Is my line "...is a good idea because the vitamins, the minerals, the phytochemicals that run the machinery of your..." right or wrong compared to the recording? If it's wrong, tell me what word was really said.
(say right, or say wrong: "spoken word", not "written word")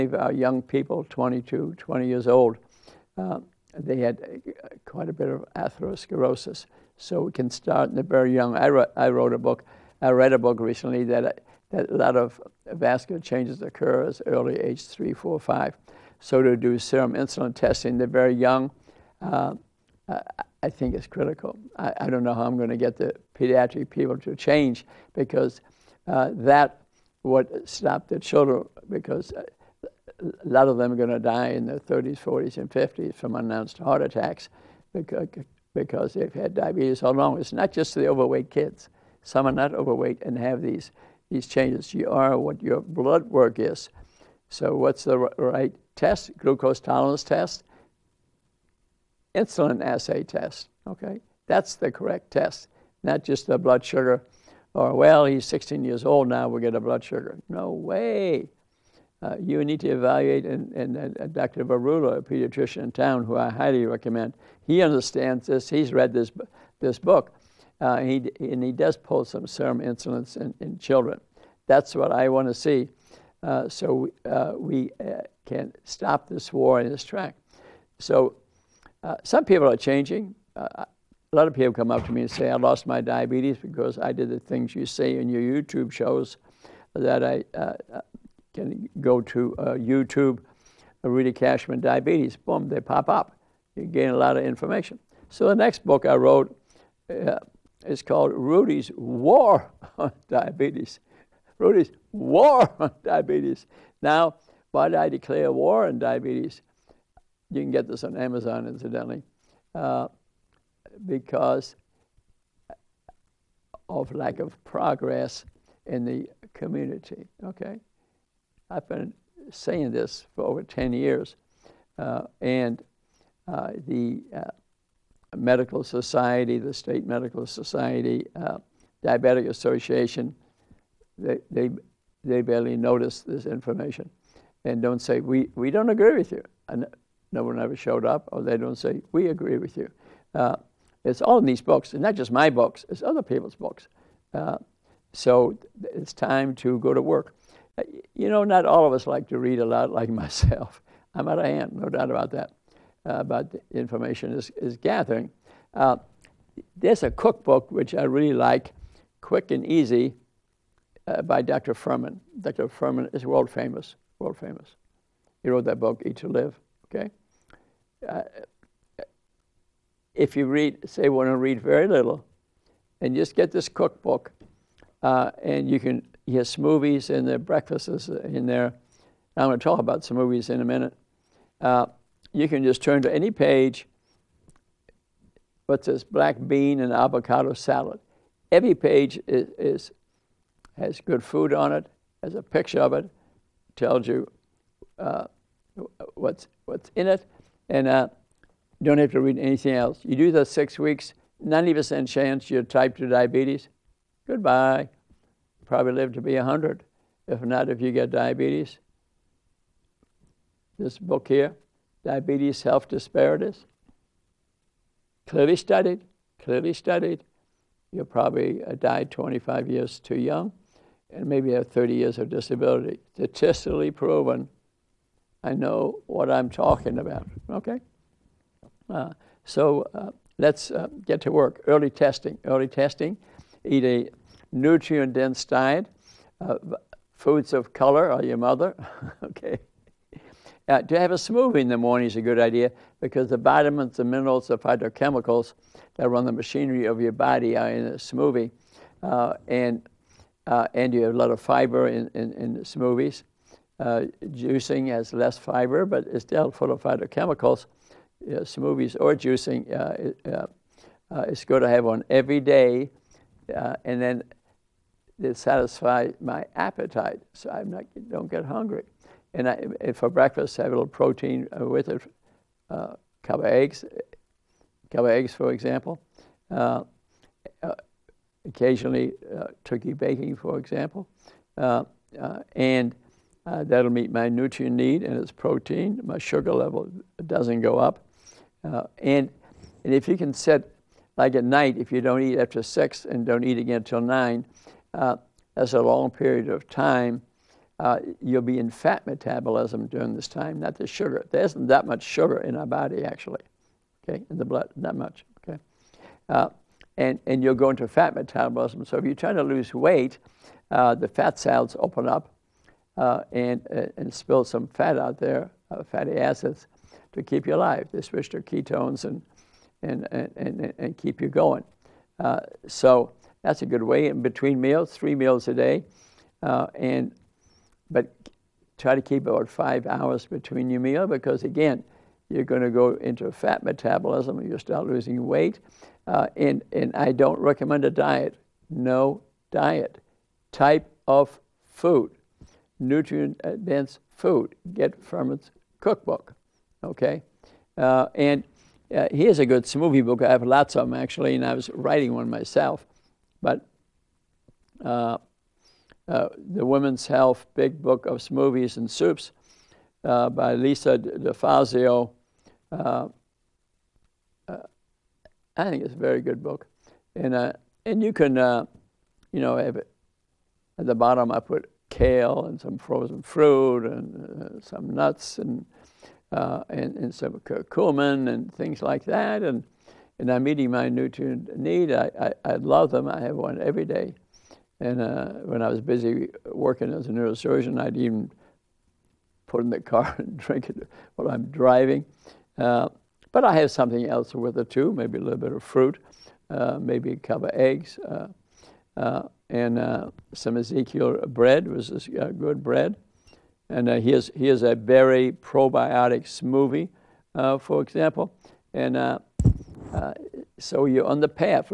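right.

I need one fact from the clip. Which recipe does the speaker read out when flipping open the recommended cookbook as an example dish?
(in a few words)
Black bean and avocado salad.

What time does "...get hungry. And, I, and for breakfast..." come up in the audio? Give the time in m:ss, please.
4:28.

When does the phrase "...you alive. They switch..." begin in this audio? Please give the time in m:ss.
5:17.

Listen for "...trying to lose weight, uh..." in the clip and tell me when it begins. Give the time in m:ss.
5:09.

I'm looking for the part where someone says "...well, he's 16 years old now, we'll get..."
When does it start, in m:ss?
0:54.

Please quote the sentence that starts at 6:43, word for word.
And here's, here's a berry probiotic smoothie, for example.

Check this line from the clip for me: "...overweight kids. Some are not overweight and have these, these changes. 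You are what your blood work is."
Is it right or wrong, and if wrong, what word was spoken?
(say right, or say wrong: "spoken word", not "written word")
right.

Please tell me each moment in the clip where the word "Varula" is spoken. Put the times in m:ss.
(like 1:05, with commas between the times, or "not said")
1:01.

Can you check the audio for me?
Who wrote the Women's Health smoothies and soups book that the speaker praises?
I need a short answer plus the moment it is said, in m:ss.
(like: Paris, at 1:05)
Lisa DeFazio, at 6:00.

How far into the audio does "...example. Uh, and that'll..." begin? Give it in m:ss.
4:40.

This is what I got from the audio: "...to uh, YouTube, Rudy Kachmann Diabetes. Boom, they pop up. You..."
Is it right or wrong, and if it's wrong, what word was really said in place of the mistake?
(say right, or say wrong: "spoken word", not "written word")
right.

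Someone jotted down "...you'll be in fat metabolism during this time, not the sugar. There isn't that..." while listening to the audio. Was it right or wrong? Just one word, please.
right.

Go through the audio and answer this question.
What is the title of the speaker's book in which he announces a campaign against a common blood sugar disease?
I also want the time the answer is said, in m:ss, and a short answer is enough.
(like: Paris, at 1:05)
Rudy's War on Diabetes, at 1:38.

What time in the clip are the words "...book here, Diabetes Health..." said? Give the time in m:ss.
3:30.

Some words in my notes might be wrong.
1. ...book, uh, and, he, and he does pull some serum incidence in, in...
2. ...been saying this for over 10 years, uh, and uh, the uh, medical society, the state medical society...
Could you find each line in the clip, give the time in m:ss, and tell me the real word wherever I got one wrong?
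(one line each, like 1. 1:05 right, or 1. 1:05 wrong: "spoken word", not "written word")
1. 1:06 right
2. 1:58 right.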